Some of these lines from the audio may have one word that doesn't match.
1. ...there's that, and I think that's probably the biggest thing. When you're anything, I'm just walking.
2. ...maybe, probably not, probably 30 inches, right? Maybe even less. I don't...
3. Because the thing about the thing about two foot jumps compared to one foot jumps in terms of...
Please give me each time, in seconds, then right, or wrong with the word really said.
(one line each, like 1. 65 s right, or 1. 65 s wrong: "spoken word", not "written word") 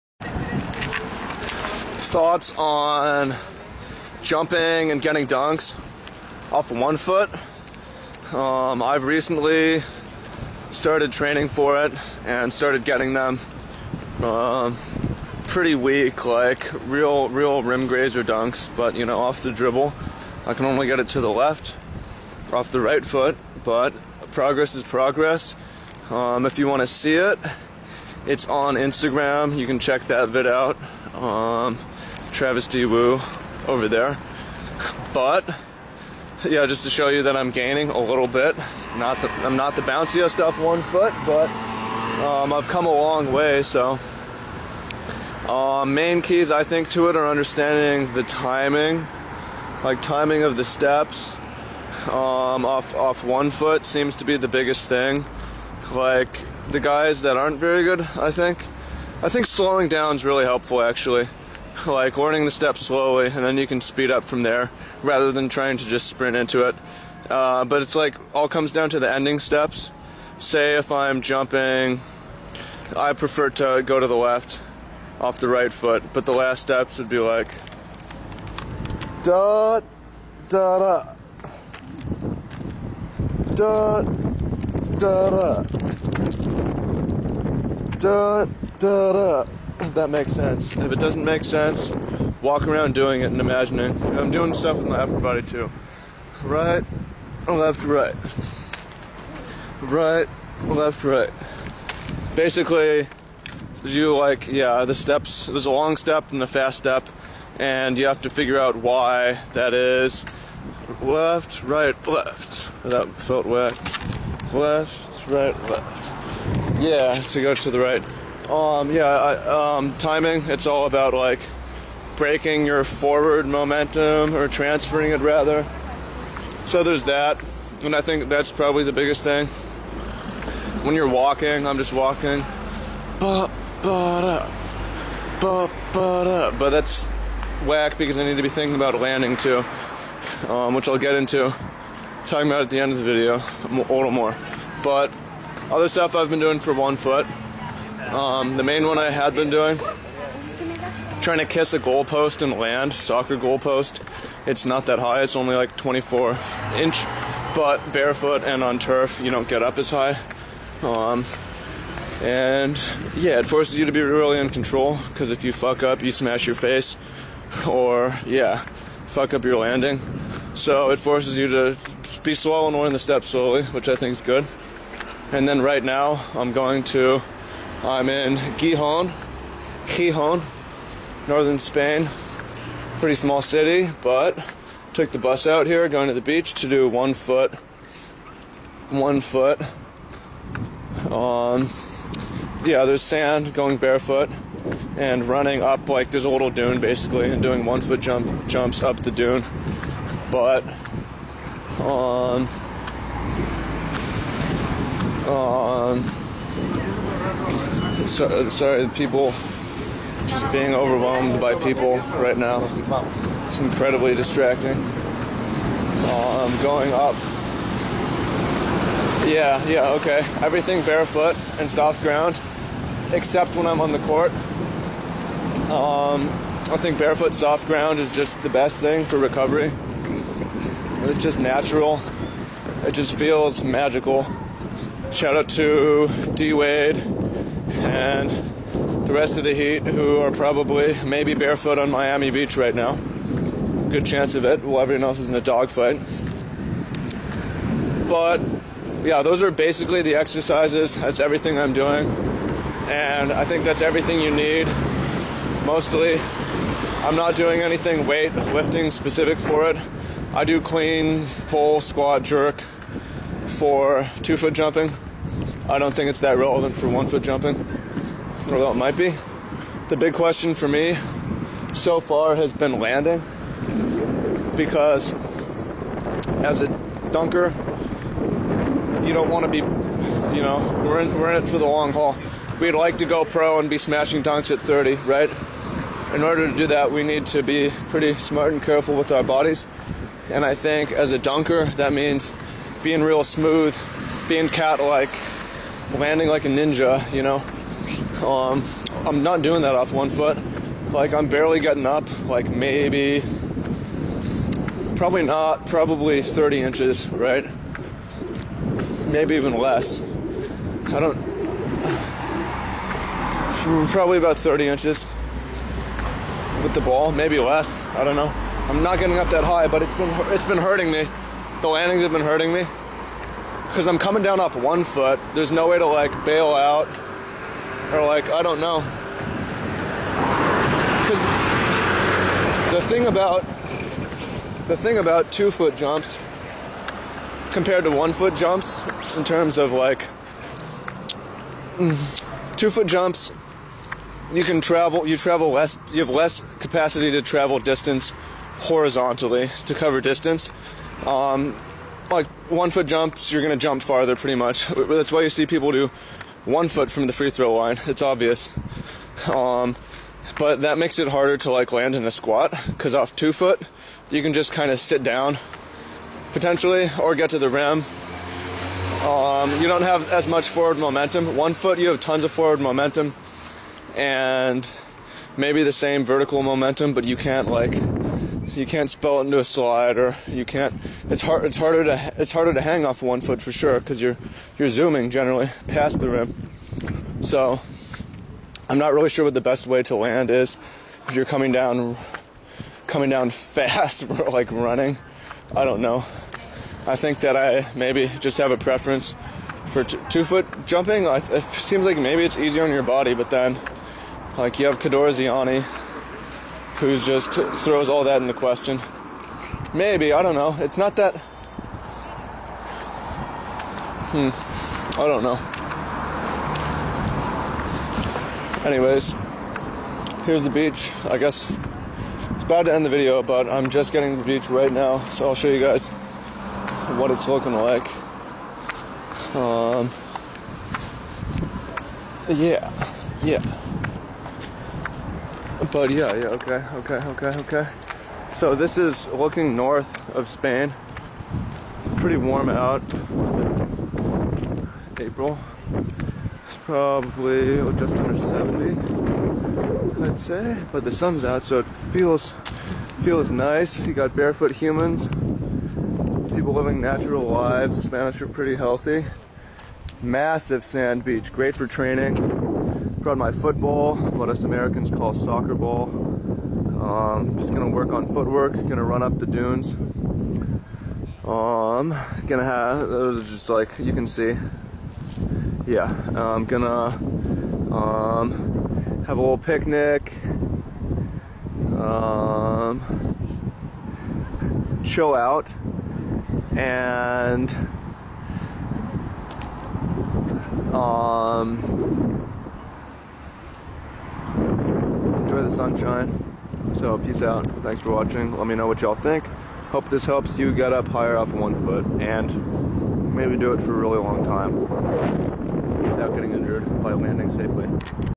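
1. 126 s wrong: "walking", not "anything"
2. 302 s right
3. 331 s right.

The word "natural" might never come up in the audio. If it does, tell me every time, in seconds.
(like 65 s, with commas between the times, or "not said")
231 s, 456 s.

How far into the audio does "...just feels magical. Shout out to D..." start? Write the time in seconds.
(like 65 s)
232 s.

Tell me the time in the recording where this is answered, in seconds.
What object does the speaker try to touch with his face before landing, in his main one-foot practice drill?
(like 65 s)
152 s.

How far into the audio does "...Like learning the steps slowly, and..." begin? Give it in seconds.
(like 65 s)
61 s.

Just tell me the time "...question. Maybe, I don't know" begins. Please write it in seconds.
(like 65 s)
408 s.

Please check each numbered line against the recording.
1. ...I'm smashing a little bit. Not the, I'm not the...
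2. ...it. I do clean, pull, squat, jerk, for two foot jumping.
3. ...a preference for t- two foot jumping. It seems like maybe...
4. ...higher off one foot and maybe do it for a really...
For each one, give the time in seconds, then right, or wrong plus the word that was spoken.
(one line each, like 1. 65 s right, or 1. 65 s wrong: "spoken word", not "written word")
1. 37 s wrong: "gaining", not "smashing"
2. 259 s right
3. 398 s right
4. 500 s right.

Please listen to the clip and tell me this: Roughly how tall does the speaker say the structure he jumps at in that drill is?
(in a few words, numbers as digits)
24 inches.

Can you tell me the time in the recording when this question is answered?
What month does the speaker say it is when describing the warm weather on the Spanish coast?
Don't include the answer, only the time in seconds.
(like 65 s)
444 s.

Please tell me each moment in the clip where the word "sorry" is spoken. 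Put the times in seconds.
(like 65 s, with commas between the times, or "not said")
208 s.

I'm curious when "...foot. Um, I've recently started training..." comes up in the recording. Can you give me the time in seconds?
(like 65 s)
6 s.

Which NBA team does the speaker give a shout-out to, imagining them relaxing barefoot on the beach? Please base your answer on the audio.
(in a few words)
the Heat.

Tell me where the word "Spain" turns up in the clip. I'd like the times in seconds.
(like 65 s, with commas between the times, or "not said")
181 s, 440 s.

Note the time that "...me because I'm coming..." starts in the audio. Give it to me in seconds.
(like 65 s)
322 s.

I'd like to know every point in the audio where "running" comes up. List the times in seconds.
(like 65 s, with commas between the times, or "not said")
195 s, 394 s.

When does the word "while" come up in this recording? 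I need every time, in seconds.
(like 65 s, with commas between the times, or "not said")
244 s.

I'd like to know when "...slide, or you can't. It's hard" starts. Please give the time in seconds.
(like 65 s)
379 s.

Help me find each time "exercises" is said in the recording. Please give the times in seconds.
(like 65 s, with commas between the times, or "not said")
250 s.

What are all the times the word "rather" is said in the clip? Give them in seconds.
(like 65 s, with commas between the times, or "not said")
65 s, 125 s.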